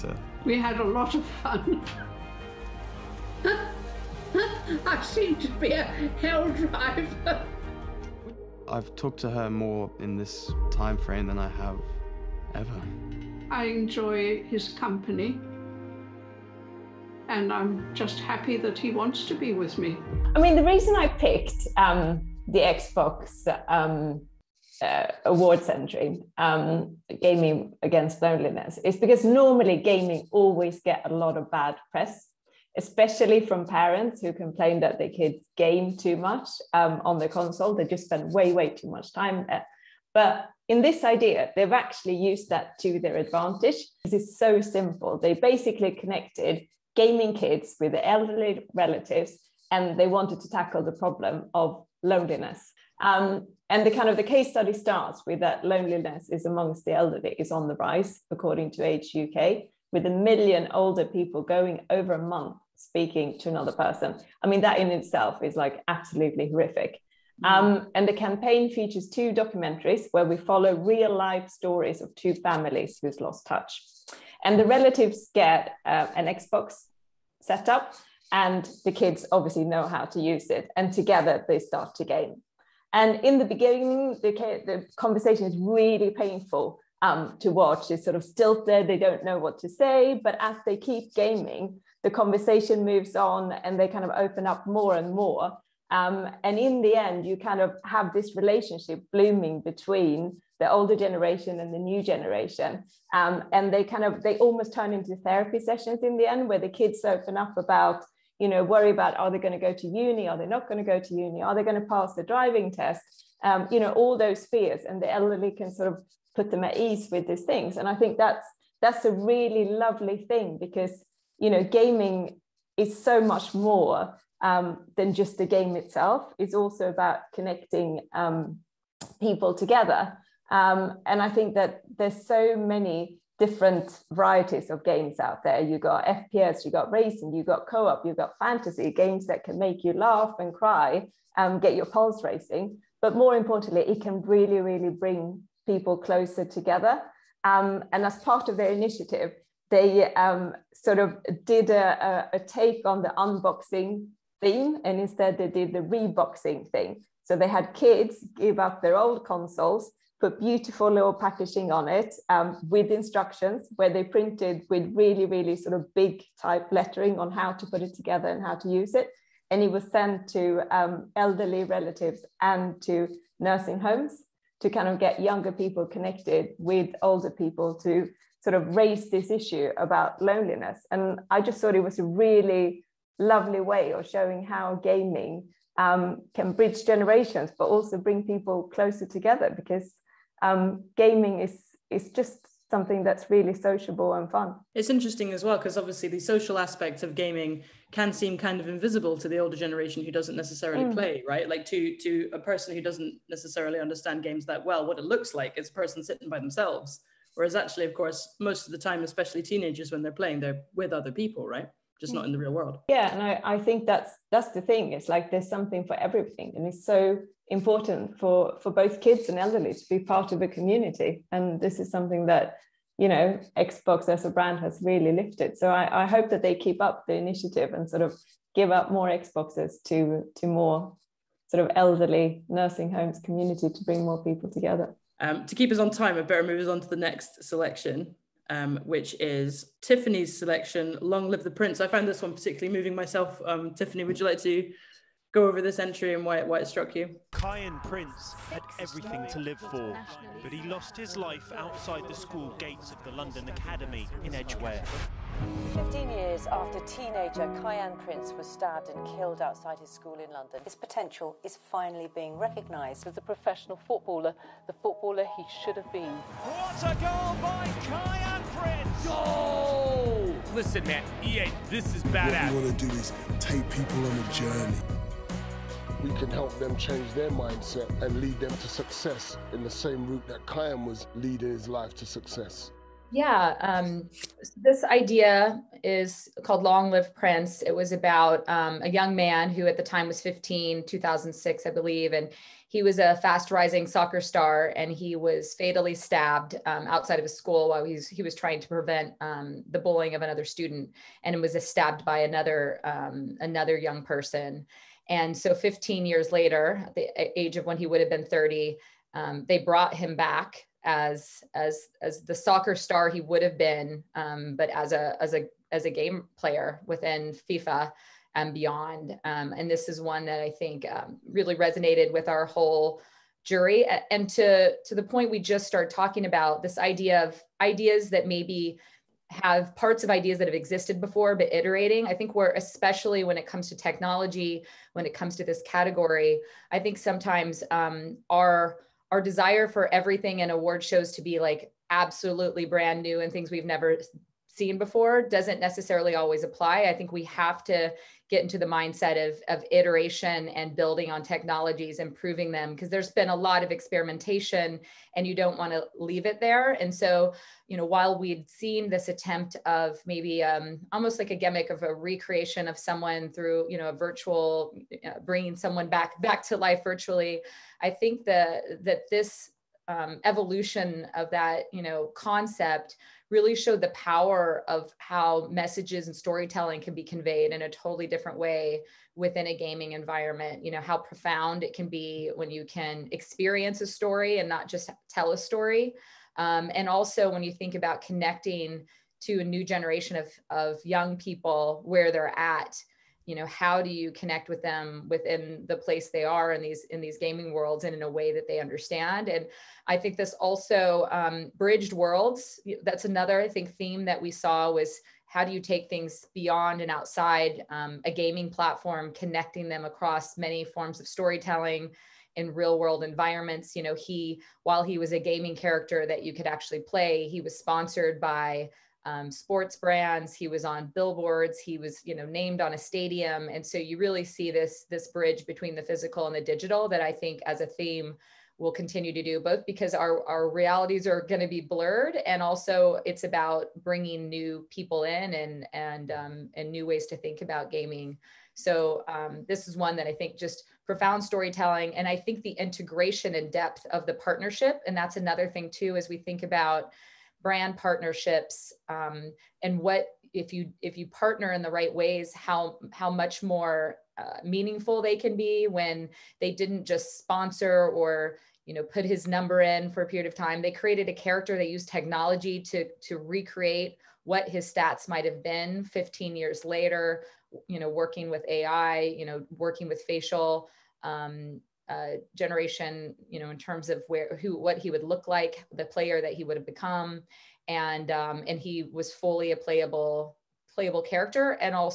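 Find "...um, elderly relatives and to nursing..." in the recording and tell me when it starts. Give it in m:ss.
2:50.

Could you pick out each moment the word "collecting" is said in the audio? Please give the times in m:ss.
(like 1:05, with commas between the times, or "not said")
not said.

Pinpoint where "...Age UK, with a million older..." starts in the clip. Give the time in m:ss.
0:58.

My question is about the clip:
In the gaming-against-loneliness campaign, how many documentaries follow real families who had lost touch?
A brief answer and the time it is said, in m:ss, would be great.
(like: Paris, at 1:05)
2, at 1:09.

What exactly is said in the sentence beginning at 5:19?
Um, and this is one that I think um, really resonated with our whole jury.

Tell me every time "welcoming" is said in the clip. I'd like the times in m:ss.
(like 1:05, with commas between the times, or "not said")
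not said.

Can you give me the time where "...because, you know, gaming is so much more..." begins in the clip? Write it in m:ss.
2:00.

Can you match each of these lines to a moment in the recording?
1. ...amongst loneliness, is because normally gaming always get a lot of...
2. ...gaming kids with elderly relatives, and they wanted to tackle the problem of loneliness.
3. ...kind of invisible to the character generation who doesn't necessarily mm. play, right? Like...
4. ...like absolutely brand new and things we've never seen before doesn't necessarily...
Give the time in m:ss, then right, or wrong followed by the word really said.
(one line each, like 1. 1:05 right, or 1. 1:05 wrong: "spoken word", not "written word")
1. 0:27 wrong: "against", not "amongst"
2. 0:46 right
3. 3:18 wrong: "older", not "character"
4. 5:41 right.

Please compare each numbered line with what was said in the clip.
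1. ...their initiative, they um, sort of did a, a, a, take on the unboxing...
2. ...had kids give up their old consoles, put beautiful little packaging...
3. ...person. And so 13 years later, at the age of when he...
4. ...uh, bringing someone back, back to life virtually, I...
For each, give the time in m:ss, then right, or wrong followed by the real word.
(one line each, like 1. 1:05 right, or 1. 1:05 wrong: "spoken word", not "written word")
1. 2:28 right
2. 2:37 right
3. 5:04 wrong: "15", not "13"
4. 6:05 right.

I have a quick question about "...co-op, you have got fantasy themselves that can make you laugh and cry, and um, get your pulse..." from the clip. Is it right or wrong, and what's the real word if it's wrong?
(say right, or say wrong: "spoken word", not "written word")
wrong: "games", not "themselves".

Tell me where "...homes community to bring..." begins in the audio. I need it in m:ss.
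3:52.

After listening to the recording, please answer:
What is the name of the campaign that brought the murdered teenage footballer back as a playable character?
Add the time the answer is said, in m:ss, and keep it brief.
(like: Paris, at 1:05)
Long Live Prince, at 4:46.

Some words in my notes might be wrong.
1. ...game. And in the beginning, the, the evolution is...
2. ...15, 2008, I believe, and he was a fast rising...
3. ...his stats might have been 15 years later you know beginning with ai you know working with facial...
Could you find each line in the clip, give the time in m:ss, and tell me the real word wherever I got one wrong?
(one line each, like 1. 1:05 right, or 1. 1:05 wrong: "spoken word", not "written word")
1. 1:22 wrong: "conversation", not "evolution"
2. 4:50 wrong: "2006", not "2008"
3. 7:44 wrong: "working", not "beginning".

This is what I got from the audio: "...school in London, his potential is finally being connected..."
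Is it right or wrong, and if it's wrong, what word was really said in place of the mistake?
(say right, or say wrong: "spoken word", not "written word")
wrong: "recognised", not "connected".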